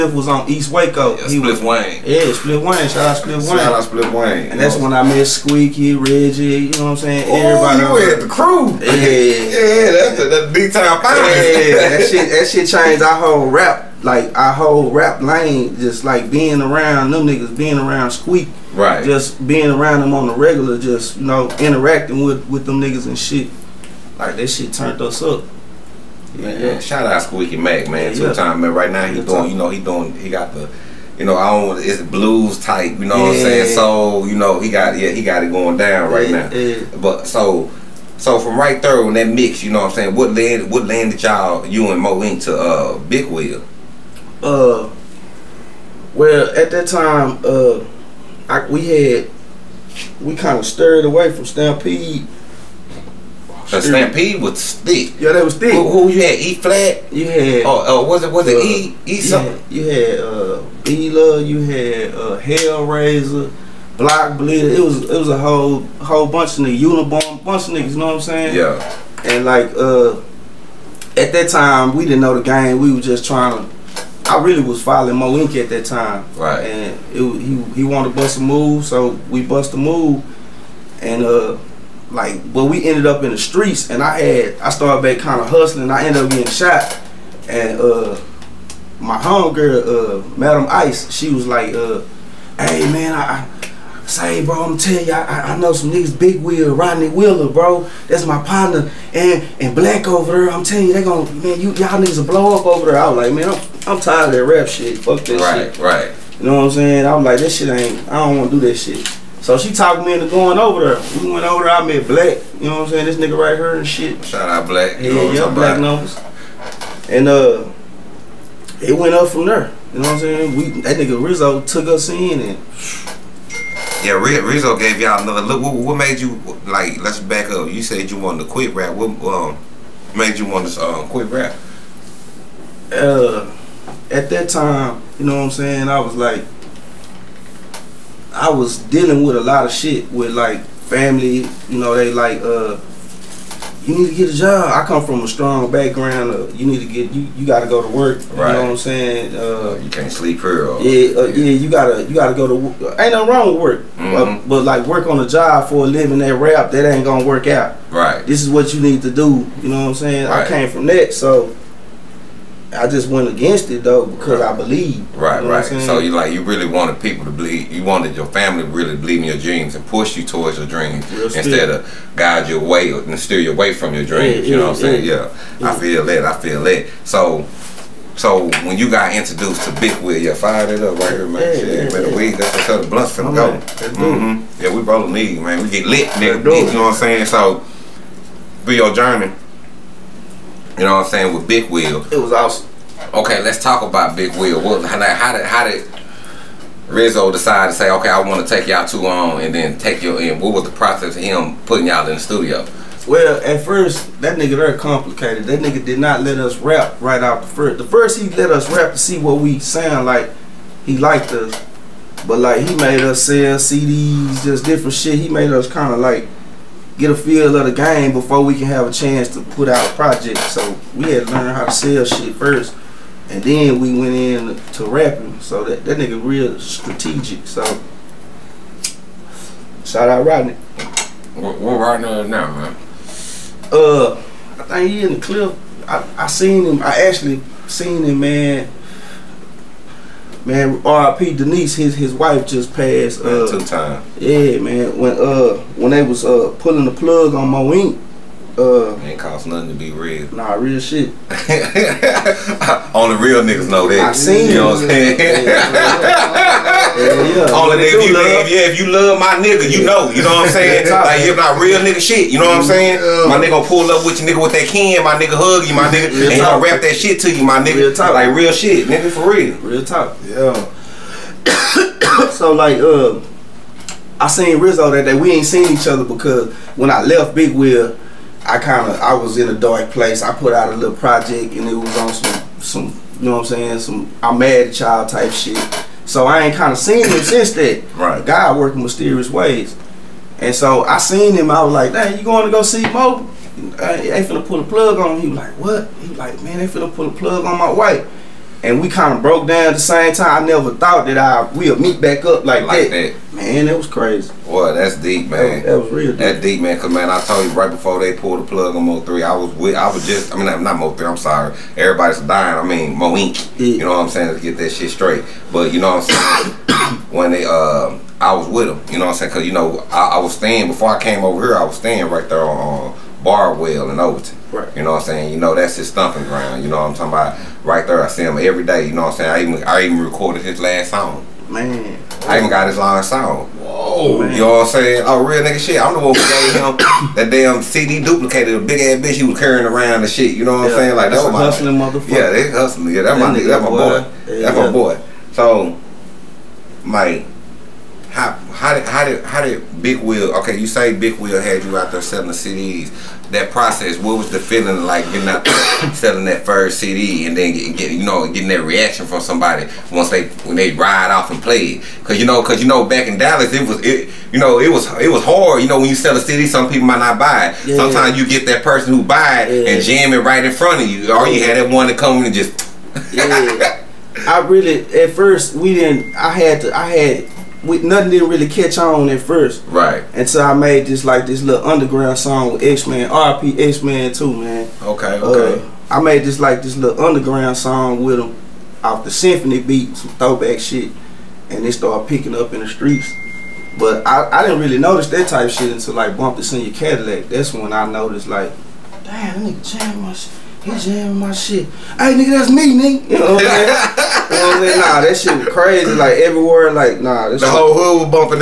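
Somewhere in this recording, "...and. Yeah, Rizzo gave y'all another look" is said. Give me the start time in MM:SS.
02:02.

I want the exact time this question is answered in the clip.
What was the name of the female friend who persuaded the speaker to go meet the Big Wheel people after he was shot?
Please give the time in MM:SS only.
01:30.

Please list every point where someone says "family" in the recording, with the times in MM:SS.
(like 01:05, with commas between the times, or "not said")
02:20, 02:48.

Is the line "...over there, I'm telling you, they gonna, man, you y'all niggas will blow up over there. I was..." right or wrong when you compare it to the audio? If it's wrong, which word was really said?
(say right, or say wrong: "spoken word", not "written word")
right.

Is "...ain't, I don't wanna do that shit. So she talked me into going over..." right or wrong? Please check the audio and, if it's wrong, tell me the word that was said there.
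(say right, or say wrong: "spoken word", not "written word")
right.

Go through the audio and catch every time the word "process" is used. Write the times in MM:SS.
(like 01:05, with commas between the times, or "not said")
03:20, 05:53.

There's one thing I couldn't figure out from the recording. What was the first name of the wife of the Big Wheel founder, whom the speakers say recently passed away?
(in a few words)
Denise.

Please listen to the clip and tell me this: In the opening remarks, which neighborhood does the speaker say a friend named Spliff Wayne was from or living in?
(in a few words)
East Waco.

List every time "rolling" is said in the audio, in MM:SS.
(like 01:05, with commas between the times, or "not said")
03:04.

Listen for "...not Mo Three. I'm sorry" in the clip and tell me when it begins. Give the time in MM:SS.
05:10.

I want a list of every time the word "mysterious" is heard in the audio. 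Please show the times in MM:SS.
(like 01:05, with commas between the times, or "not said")
04:48.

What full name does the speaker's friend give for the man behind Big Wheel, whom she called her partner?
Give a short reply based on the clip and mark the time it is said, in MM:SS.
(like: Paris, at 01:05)
Rodney Wheeler, at 01:36.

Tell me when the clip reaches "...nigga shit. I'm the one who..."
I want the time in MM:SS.
05:35.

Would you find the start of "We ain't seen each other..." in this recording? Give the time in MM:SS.
04:35.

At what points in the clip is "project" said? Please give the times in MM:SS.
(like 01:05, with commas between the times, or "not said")
03:39, 04:40.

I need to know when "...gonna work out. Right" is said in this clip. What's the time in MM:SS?
02:37.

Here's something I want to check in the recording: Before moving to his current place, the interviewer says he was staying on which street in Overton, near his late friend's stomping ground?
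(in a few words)
Barwell.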